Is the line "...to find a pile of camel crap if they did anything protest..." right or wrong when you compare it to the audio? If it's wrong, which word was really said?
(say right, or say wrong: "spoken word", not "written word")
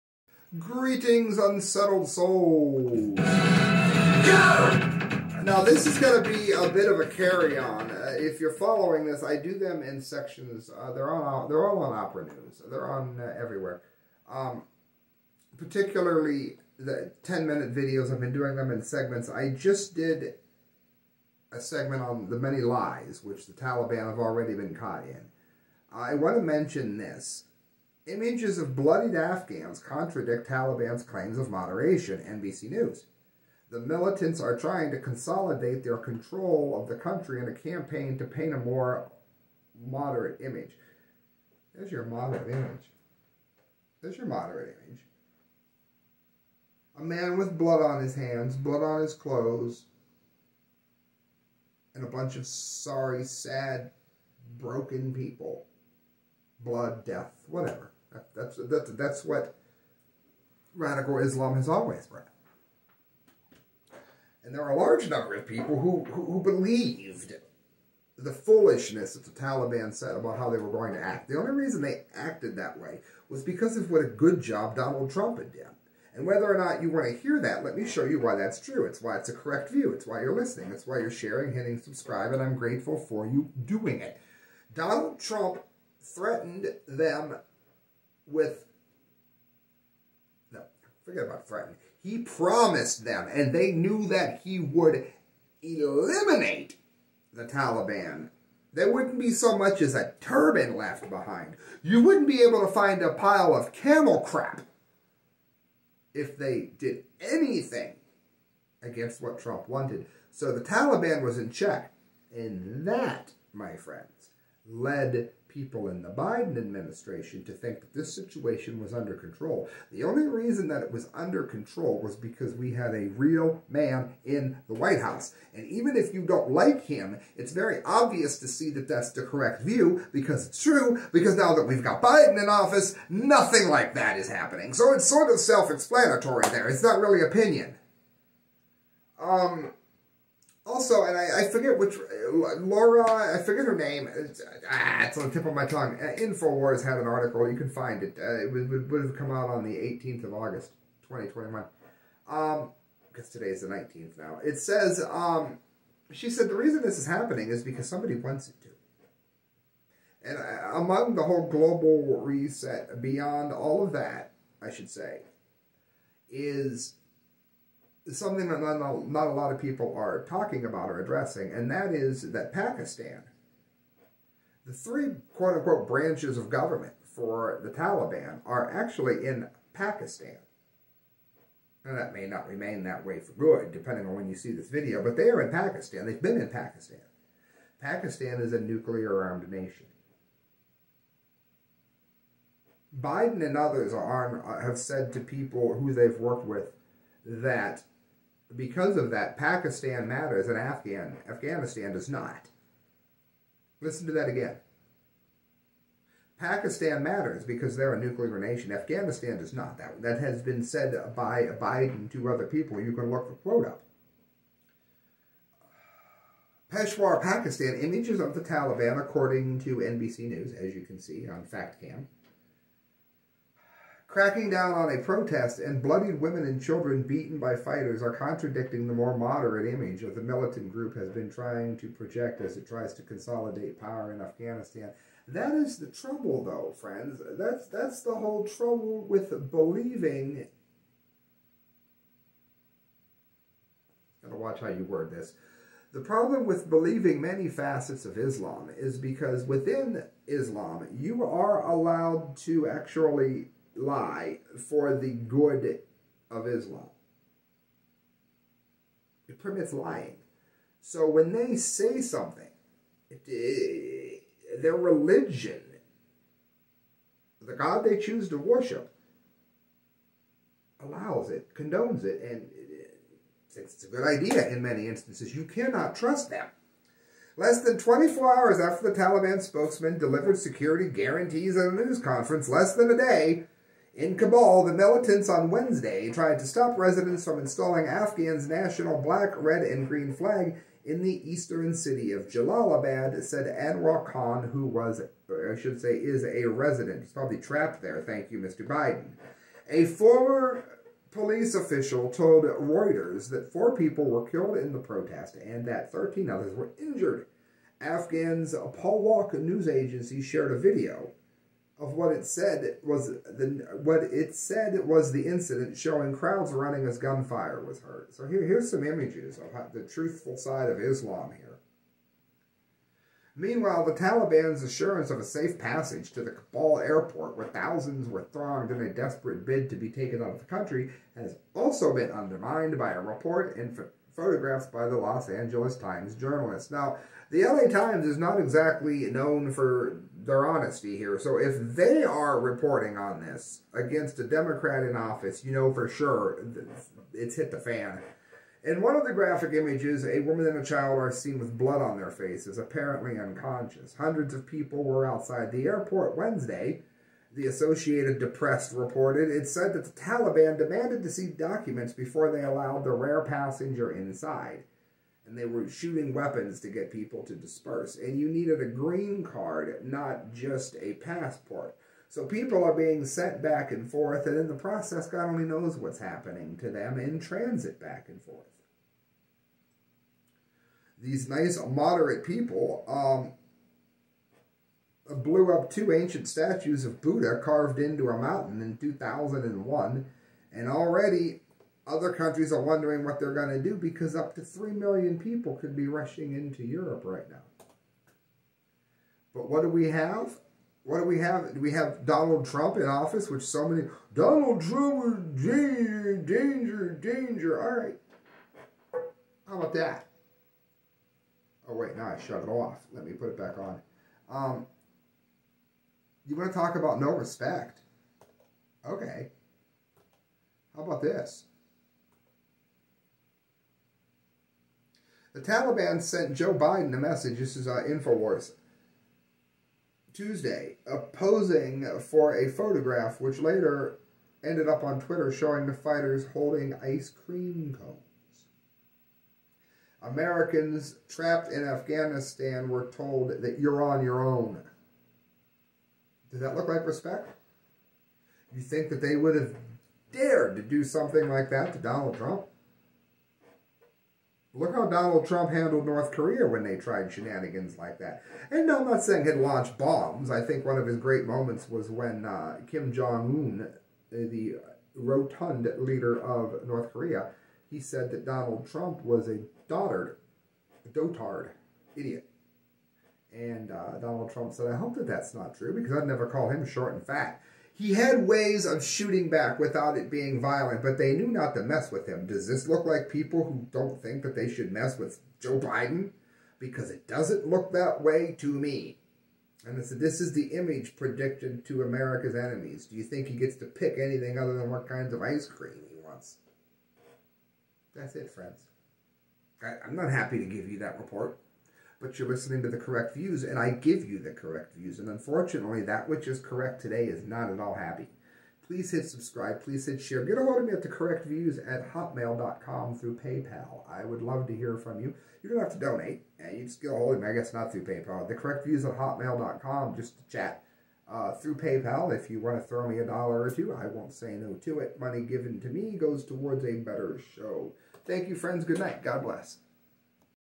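wrong: "against", not "protest".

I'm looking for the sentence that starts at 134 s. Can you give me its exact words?
So it's sort of self-explanatory there.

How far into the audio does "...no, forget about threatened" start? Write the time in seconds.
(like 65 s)
90 s.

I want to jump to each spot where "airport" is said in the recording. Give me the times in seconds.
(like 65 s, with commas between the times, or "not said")
326 s, 355 s.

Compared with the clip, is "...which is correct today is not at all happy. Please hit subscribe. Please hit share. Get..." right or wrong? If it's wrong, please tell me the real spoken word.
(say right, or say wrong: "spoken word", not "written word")
right.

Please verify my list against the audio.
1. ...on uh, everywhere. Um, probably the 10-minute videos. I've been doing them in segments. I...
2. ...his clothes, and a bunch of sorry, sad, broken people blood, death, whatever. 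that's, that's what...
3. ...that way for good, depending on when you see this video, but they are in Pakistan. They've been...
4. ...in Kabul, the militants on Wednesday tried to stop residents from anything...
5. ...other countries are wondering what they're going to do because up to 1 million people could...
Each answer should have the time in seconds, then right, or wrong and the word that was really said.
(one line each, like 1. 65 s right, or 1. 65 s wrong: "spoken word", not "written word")
1. 12 s wrong: "particularly", not "probably"
2. 49 s right
3. 182 s right
4. 283 s wrong: "installing", not "anything"
5. 391 s wrong: "3", not "1".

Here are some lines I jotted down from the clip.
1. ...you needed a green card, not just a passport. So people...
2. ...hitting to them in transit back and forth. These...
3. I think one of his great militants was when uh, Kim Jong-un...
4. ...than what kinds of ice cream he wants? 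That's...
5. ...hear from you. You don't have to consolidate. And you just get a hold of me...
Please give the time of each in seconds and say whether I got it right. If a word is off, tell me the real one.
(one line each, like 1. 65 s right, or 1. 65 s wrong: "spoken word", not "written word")
1. 368 s right
2. 375 s wrong: "happening", not "hitting"
3. 460 s wrong: "moments", not "militants"
4. 494 s right
5. 514 s wrong: "donate", not "consolidate".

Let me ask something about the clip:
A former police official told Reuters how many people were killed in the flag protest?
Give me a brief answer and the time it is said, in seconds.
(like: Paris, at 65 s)
4, at 303 s.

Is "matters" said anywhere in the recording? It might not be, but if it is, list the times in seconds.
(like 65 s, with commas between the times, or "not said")
200 s, 207 s.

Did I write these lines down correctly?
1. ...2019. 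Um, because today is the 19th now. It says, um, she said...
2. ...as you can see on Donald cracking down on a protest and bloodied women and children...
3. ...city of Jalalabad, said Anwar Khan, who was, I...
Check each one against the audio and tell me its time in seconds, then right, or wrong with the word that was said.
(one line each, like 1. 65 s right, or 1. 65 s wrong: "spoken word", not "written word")
1. 151 s wrong: "2021", not "2019"
2. 220 s wrong: "FactCam", not "Donald"
3. 291 s right.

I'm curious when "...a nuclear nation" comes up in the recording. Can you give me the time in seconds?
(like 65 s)
207 s.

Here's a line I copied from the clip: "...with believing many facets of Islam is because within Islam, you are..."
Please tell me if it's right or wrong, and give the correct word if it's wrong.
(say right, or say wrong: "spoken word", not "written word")
right.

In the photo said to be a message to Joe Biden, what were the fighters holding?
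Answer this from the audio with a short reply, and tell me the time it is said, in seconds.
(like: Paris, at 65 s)
ice cream cones, at 436 s.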